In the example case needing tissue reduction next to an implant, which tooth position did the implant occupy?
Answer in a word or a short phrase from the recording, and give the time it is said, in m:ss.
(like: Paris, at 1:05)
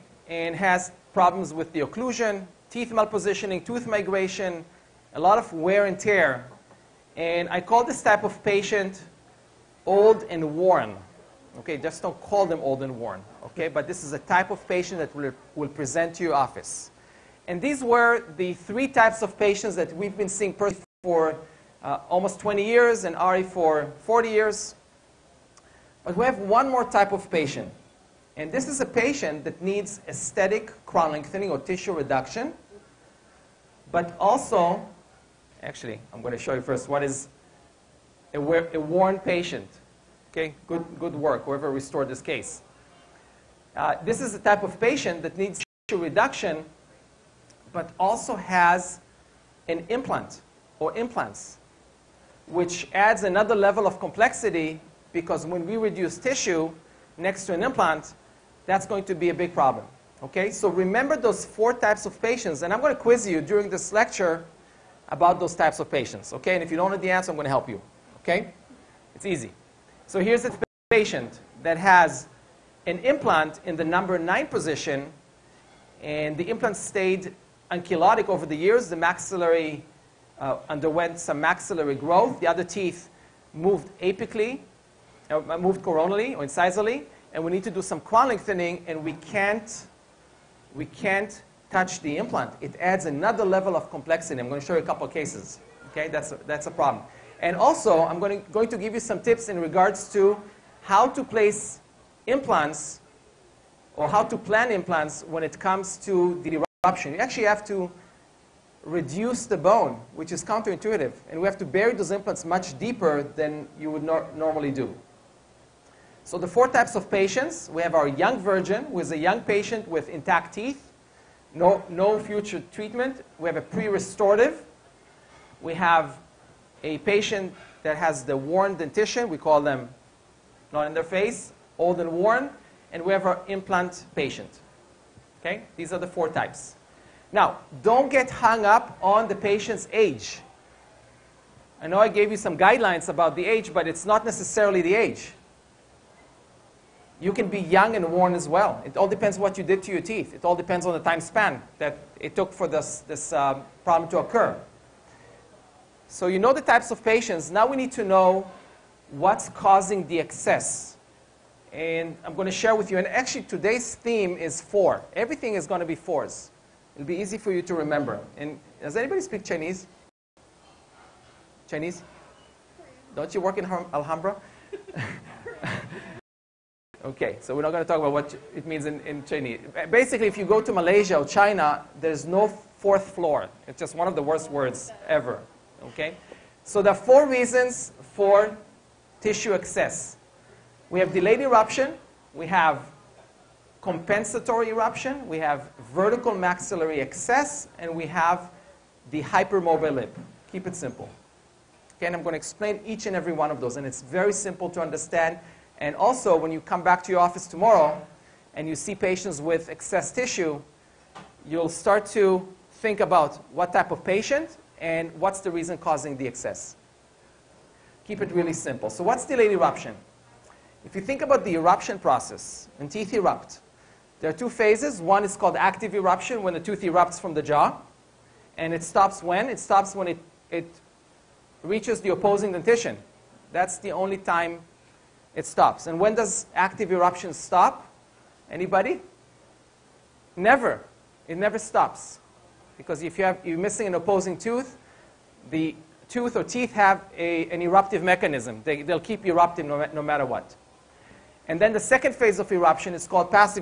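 Number 9, at 1:13.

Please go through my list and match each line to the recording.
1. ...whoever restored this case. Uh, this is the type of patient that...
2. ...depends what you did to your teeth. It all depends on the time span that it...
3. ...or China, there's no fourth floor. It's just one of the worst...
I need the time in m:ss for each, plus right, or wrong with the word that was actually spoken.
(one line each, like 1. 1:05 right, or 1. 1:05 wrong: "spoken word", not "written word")
1. 0:41 right
2. 2:29 right
3. 3:01 right.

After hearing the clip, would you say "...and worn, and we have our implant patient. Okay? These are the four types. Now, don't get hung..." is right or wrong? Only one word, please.
right.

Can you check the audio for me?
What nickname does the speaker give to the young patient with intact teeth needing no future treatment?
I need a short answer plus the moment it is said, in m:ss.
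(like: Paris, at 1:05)
Young virgin, at 1:58.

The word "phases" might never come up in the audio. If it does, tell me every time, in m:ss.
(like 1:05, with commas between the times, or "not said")
3:44, 4:12.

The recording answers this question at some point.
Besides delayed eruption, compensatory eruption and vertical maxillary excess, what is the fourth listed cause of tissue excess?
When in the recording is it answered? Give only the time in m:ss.
3:19.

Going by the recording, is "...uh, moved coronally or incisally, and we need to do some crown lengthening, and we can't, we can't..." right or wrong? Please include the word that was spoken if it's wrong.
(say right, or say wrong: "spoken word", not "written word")
right.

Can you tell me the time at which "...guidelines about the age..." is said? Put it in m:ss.
2:22.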